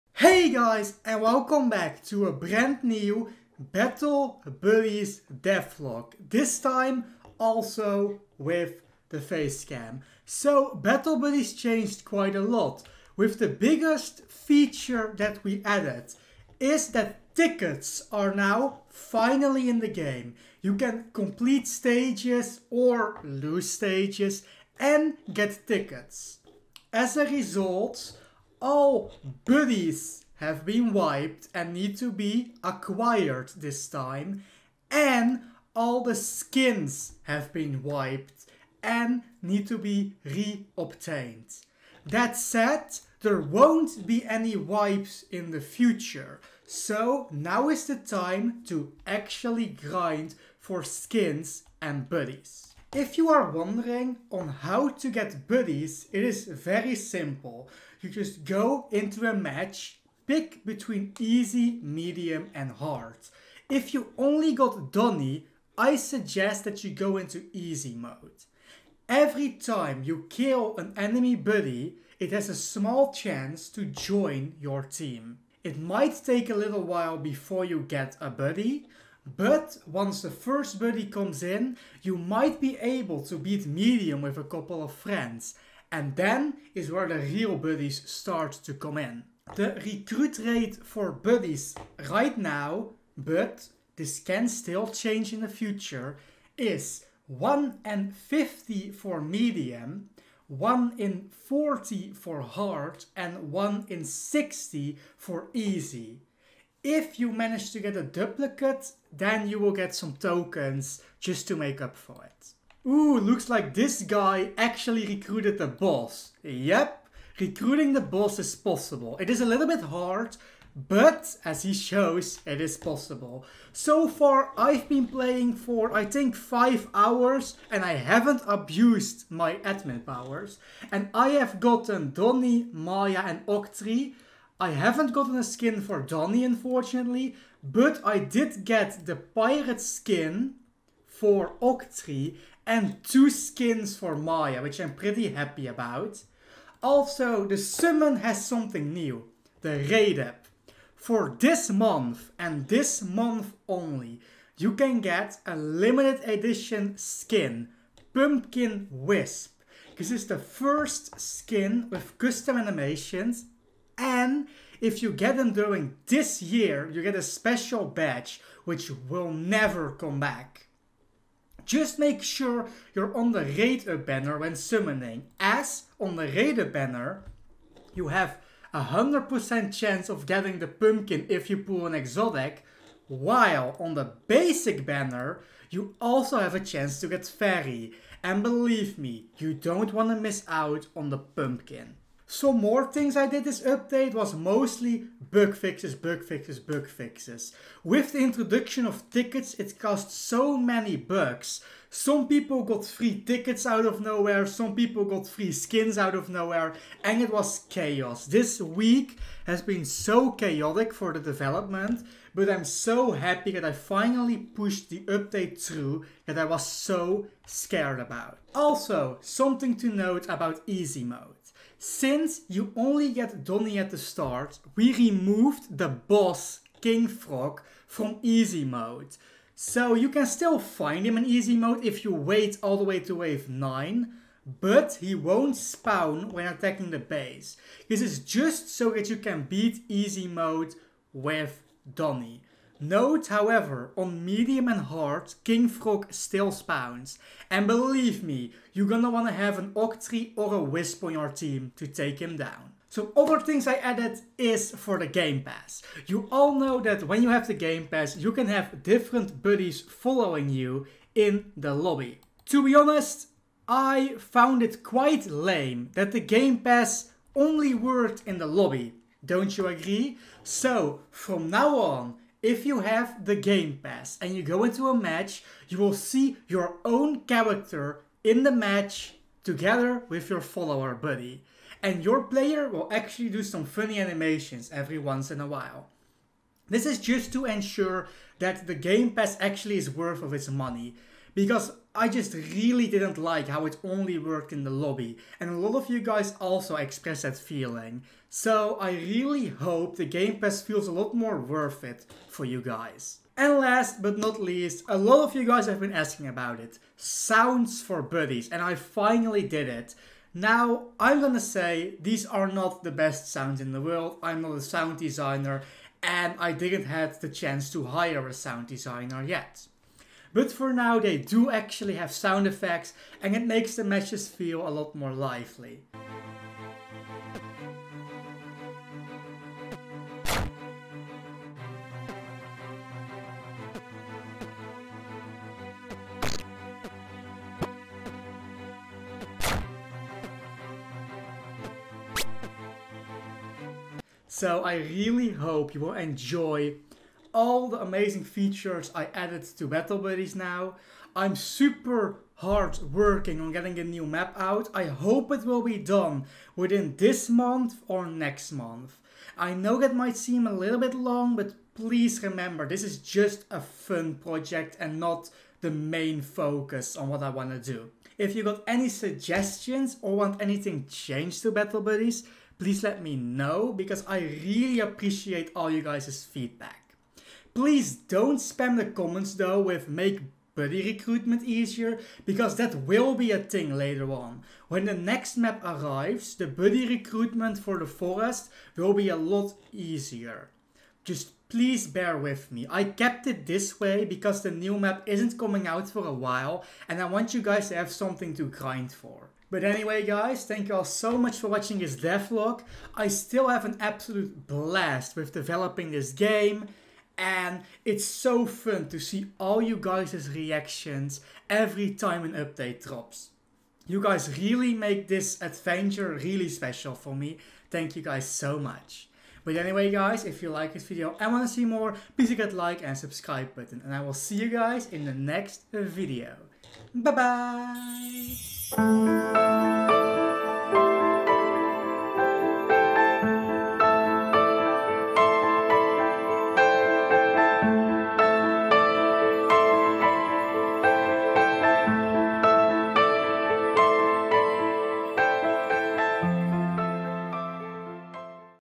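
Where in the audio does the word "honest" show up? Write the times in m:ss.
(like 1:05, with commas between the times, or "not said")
4:22.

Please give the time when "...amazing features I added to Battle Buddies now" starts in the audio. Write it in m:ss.
5:47.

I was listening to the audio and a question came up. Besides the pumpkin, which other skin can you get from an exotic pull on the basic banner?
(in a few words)
Fairy.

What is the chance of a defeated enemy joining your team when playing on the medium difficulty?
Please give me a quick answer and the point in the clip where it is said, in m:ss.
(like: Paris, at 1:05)
1 in 50, at 1:37.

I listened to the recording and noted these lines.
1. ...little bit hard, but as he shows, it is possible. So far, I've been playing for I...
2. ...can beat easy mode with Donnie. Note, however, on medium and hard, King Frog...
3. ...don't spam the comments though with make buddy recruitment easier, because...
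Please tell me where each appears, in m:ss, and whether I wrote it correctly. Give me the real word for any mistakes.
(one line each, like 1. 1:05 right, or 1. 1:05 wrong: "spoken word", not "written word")
1. 1:59 right
2. 3:59 right
3. 6:17 right.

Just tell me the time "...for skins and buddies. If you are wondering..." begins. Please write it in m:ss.
0:50.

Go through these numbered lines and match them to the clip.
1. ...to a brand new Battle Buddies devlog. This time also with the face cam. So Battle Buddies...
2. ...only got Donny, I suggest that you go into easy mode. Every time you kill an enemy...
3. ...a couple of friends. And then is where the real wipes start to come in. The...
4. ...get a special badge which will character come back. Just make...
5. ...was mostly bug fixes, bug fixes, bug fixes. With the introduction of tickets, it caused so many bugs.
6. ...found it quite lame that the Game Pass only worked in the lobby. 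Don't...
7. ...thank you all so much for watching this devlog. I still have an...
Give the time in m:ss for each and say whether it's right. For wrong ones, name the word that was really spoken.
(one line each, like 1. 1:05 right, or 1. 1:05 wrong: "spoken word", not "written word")
1. 0:02 right
2. 1:04 right
3. 1:24 wrong: "buddies", not "wipes"
4. 2:47 wrong: "never", not "character"
5. 3:14 right
6. 4:24 right
7. 6:40 right.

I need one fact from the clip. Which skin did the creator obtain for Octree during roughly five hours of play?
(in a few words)
Pirate.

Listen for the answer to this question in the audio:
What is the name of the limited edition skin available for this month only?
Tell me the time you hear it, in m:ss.
2:38.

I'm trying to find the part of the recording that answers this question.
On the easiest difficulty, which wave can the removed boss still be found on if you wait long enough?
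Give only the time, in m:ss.
3:53.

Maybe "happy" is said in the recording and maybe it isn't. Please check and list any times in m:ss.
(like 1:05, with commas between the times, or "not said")
2:25, 3:33.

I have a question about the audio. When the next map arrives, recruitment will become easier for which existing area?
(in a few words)
The forest.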